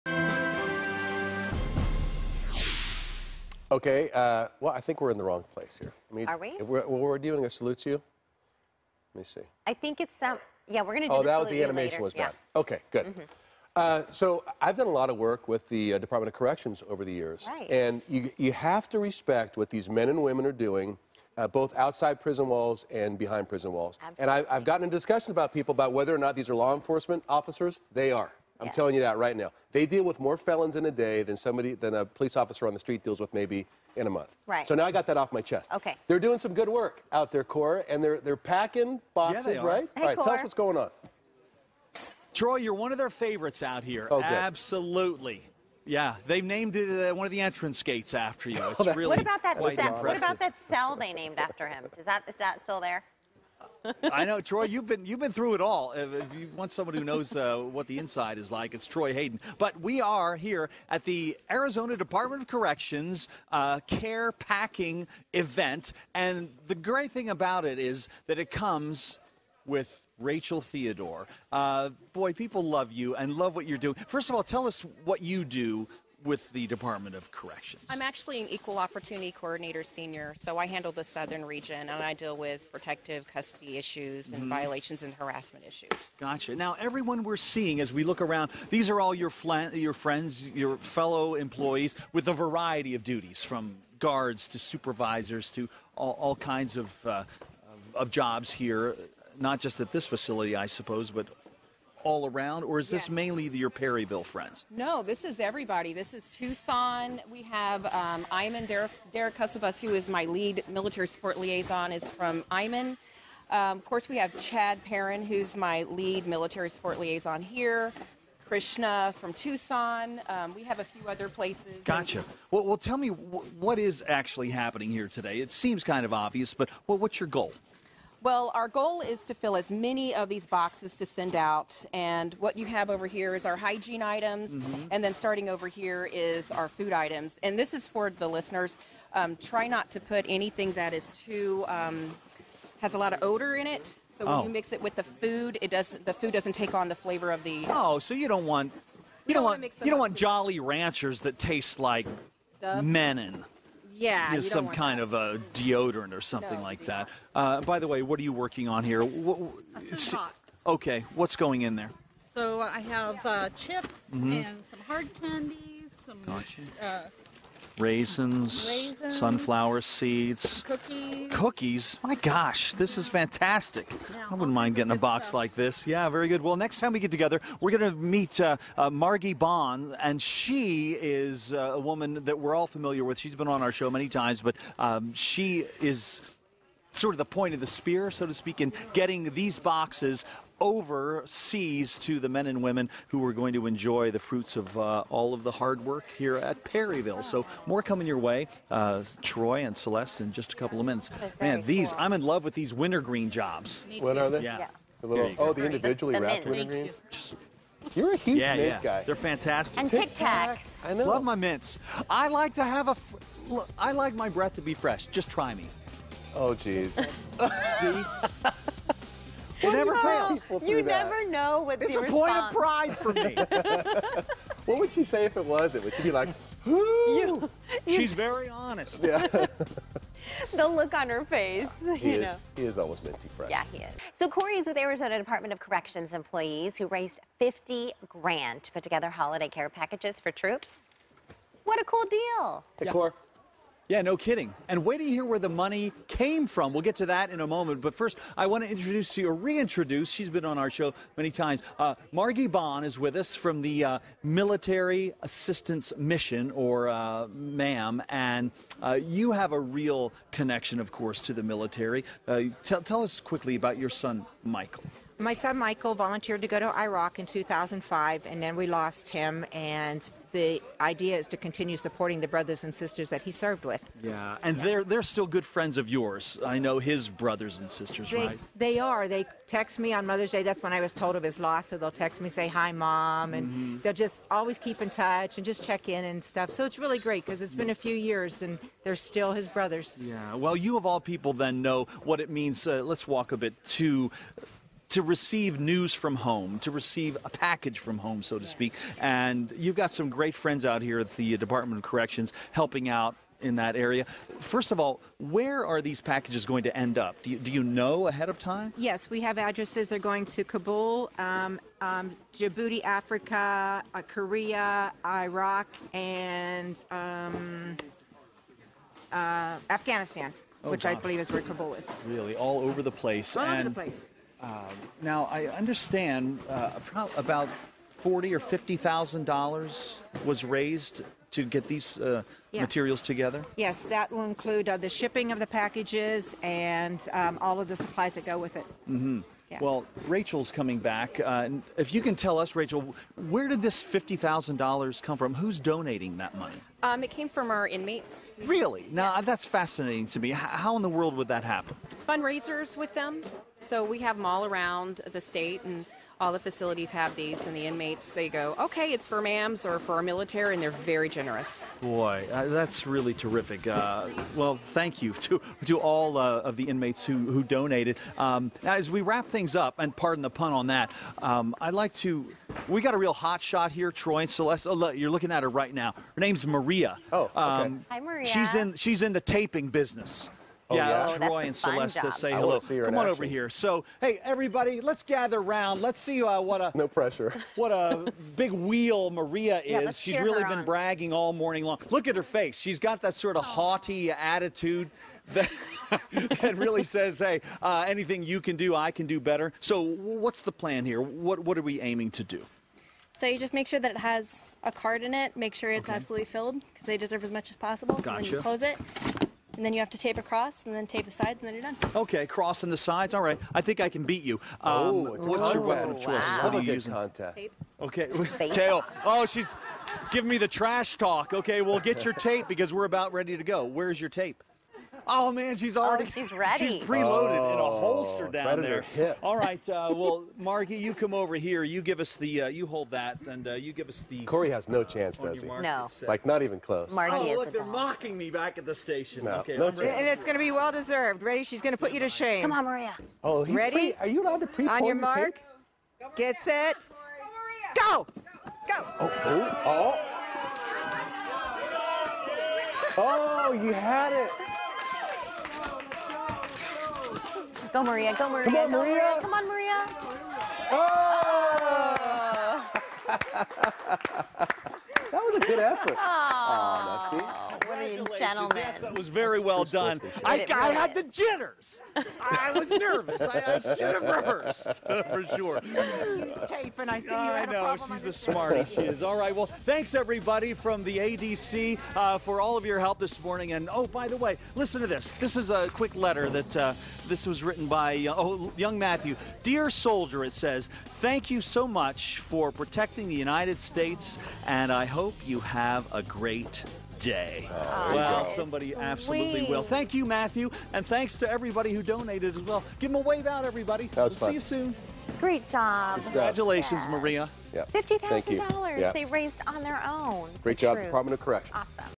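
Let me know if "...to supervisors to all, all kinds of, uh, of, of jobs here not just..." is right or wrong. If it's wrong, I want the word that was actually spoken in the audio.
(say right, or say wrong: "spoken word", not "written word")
right.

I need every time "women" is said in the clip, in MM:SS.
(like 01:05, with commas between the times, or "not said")
00:20, 03:12.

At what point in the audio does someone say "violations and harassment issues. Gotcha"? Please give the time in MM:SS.
01:24.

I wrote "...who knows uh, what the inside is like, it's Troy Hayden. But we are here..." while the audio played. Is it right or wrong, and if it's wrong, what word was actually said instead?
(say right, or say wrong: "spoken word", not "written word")
right.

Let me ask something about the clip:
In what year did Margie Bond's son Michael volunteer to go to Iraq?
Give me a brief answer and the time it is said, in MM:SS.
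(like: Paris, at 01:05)
2005, at 04:27.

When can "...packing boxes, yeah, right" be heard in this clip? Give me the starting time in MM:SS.
00:38.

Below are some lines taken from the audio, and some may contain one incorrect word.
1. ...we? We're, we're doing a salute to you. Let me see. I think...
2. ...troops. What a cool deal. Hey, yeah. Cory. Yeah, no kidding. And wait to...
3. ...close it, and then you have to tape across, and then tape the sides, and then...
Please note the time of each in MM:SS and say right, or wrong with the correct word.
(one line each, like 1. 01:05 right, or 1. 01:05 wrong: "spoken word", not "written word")
1. 00:06 right
2. 04:00 right
3. 06:48 right.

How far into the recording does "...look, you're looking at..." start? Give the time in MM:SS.
06:14.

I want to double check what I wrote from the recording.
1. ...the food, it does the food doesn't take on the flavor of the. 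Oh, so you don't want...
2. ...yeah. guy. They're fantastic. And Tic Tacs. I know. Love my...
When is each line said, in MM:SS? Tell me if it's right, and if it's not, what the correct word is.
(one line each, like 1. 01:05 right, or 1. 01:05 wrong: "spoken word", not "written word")
1. 02:24 right
2. 03:28 right.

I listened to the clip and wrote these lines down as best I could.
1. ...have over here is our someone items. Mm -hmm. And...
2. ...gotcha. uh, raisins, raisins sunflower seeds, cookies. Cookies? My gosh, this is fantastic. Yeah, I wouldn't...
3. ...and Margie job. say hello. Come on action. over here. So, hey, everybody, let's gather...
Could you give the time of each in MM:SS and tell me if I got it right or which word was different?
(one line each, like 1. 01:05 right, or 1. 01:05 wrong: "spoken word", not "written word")
1. 02:12 wrong: "hygiene", not "someone"
2. 02:46 right
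3. 06:21 wrong: "Celeste", not "Margie".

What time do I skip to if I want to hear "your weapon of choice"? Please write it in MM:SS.
06:55.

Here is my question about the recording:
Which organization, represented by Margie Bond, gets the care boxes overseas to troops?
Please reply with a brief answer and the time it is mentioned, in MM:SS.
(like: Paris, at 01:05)
Military Assistance Mission, at 04:14.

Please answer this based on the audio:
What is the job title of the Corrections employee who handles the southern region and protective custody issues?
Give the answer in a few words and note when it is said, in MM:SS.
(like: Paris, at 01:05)
Equal opportunity coordinator senior, at 01:18.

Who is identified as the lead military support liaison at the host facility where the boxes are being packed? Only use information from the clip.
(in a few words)
Chad Perrin.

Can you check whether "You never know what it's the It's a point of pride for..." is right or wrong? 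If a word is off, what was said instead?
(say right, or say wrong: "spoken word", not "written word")
right.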